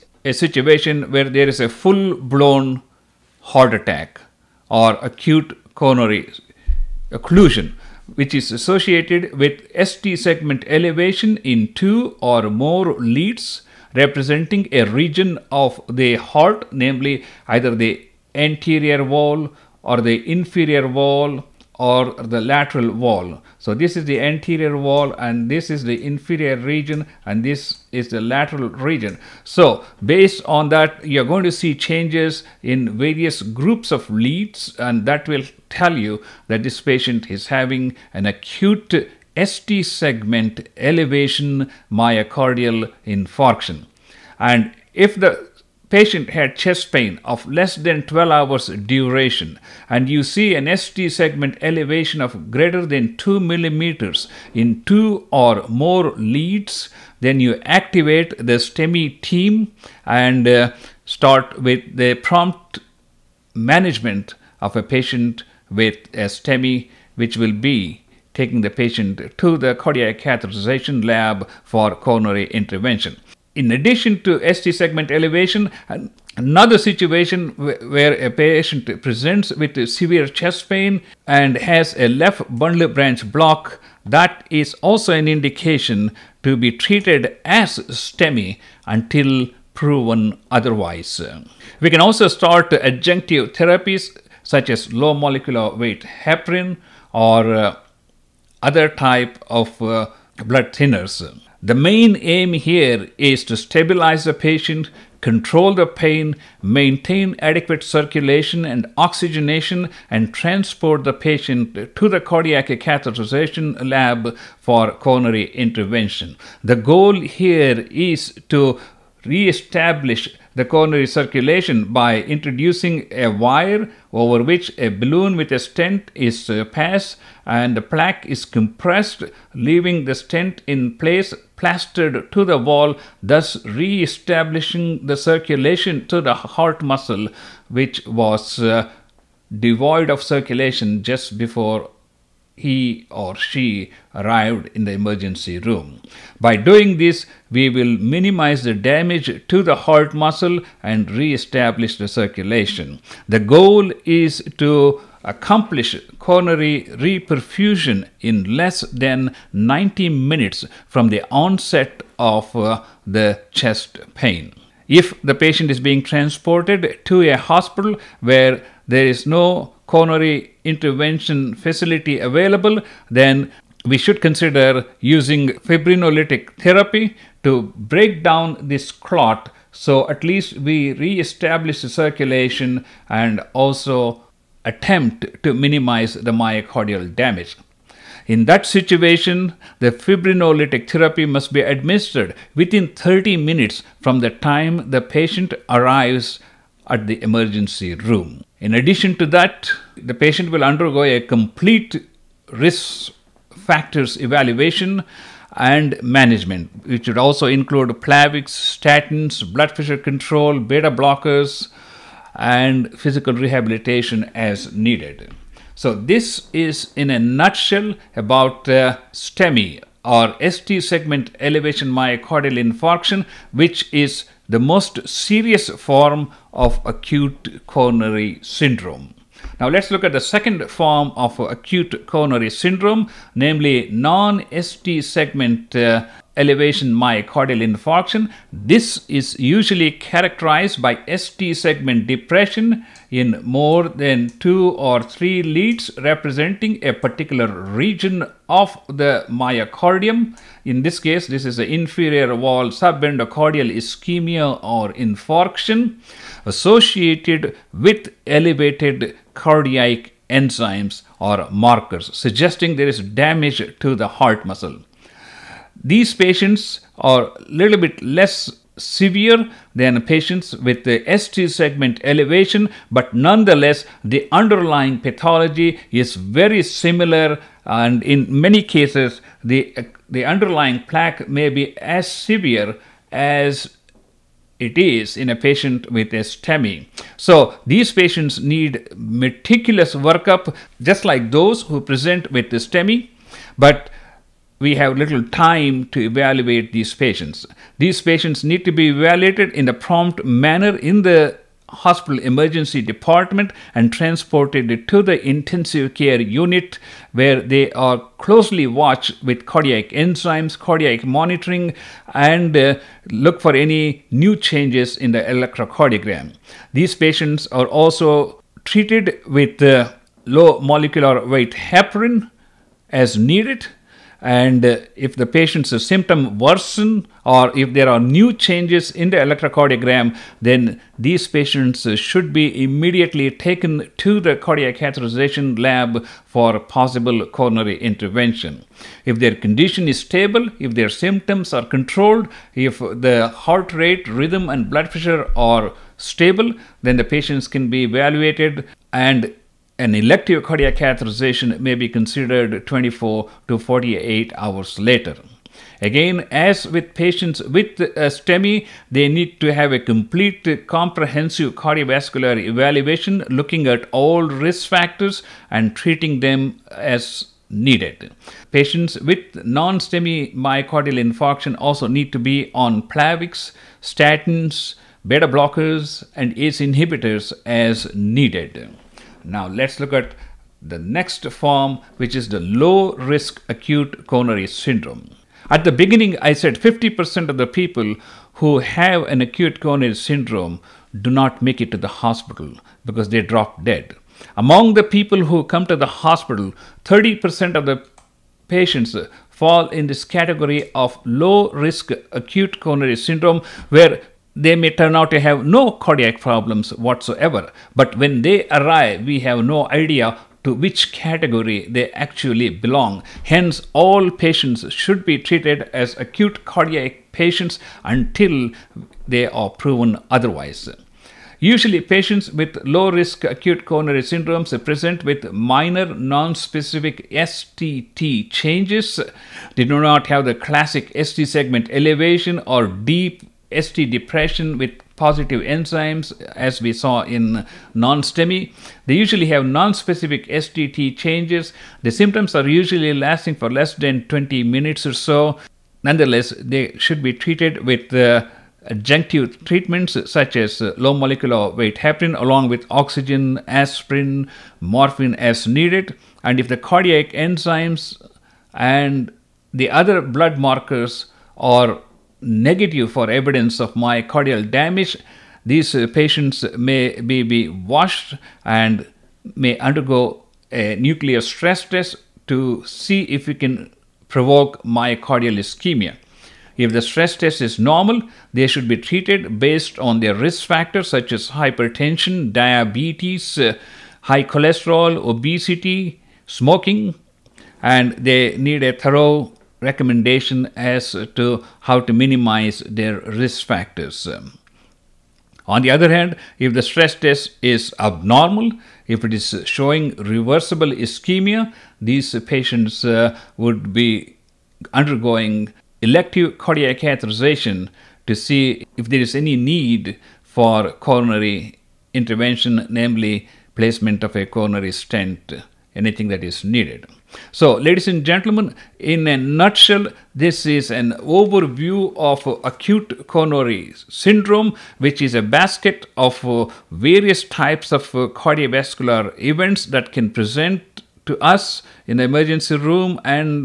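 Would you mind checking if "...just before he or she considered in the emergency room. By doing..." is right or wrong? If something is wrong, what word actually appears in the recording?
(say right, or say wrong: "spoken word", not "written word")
wrong: "arrived", not "considered".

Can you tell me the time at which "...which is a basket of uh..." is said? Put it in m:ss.
8:44.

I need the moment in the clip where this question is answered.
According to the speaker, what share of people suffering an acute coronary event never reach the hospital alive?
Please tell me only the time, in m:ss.
6:26.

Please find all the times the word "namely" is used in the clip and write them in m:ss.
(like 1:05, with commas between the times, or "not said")
0:16, 3:53, 8:32.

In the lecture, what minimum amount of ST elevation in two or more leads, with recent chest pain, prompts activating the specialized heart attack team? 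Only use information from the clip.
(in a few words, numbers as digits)
2 millimeters.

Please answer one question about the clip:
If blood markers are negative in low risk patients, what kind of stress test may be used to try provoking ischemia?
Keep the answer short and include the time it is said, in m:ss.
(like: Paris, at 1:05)
nuclear stress test, at 7:50.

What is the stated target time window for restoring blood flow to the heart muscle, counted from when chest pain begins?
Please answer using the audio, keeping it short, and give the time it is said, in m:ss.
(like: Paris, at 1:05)
90 minutes, at 2:39.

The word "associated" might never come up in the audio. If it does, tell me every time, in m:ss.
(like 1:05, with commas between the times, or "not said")
0:08, 4:16.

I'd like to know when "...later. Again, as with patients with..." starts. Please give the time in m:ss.
5:54.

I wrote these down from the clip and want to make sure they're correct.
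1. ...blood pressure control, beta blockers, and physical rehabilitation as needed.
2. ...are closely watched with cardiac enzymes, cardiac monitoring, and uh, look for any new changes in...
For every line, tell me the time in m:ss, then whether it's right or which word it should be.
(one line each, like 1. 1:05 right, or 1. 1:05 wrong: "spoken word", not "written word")
1. 3:29 right
2. 5:07 right.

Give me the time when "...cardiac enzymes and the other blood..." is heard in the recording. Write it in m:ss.
7:36.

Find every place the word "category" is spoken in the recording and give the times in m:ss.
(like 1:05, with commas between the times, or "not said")
6:40, 6:50.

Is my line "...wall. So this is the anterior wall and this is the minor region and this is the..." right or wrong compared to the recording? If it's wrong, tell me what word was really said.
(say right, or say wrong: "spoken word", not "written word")
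wrong: "inferior", not "minor".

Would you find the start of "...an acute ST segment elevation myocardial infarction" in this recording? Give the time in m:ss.
0:38.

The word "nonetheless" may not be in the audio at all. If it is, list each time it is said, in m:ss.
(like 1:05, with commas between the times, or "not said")
4:33, 7:25.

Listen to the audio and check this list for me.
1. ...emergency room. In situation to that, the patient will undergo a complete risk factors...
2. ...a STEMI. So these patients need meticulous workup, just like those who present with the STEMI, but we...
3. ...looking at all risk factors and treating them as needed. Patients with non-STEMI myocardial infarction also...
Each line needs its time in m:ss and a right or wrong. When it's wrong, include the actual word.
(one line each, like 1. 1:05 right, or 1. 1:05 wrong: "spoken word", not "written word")
1. 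3:17 wrong: "addition", not "situation"
2. 4:46 right
3. 6:03 right.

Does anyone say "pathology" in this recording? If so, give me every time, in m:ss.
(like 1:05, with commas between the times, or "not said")
4:34.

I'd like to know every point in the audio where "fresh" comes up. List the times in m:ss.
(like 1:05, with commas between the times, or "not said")
not said.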